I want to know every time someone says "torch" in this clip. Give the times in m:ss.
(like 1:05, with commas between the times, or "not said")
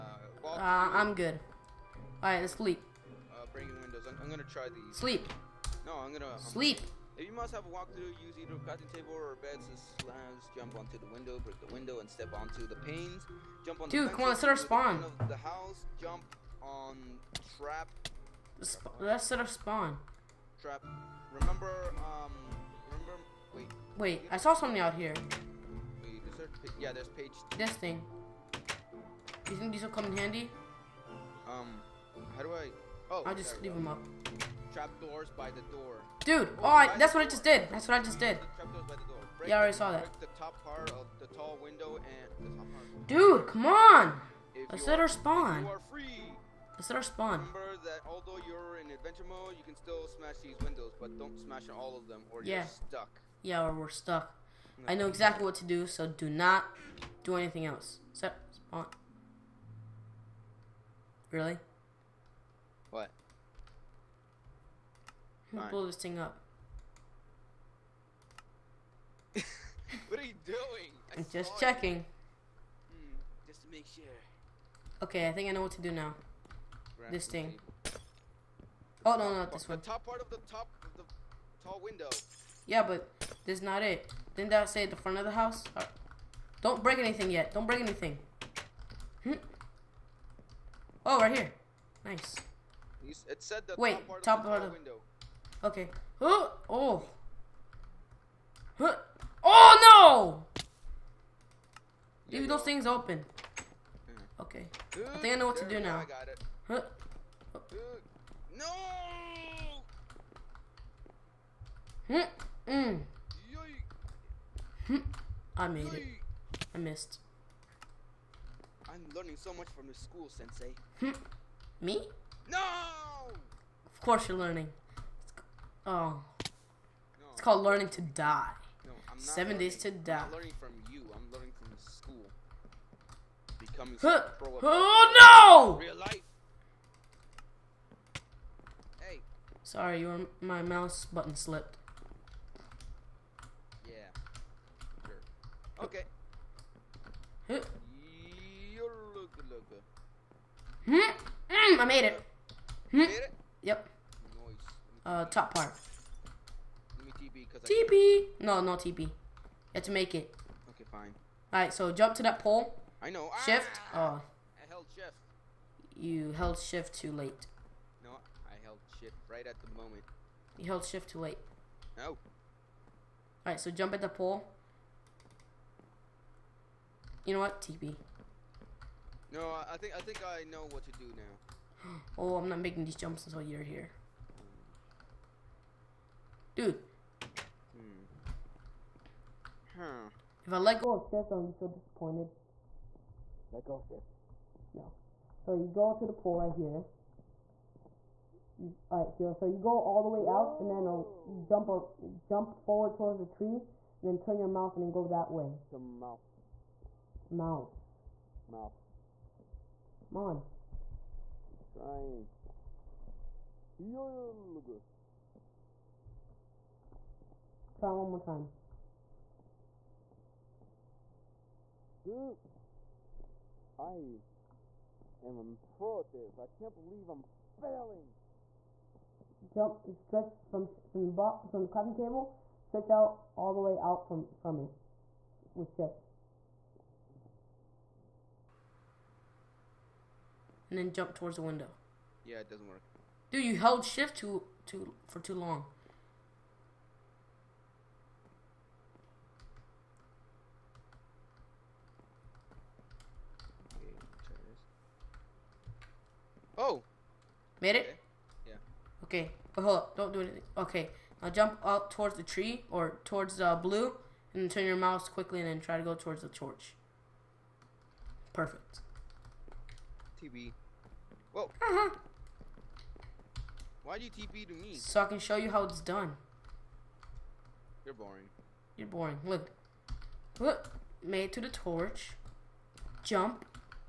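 4:26, 4:41.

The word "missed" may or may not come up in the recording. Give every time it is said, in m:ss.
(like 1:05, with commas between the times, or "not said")
1:56.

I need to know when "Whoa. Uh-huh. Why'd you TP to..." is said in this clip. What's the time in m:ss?
4:31.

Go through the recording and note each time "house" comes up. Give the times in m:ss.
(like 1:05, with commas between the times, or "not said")
0:15, 1:25.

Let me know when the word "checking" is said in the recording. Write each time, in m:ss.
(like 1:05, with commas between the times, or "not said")
1:11.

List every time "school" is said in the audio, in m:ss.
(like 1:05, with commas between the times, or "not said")
1:59, 2:11.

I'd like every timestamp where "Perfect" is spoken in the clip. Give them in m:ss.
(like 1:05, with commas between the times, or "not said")
4:28.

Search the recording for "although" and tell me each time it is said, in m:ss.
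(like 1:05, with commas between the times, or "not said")
0:48.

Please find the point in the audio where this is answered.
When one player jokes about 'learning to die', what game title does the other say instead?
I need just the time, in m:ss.
2:09.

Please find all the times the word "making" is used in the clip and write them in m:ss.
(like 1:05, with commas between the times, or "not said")
3:02.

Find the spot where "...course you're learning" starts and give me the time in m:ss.
2:04.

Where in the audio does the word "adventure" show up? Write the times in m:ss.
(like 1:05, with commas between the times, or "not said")
0:48.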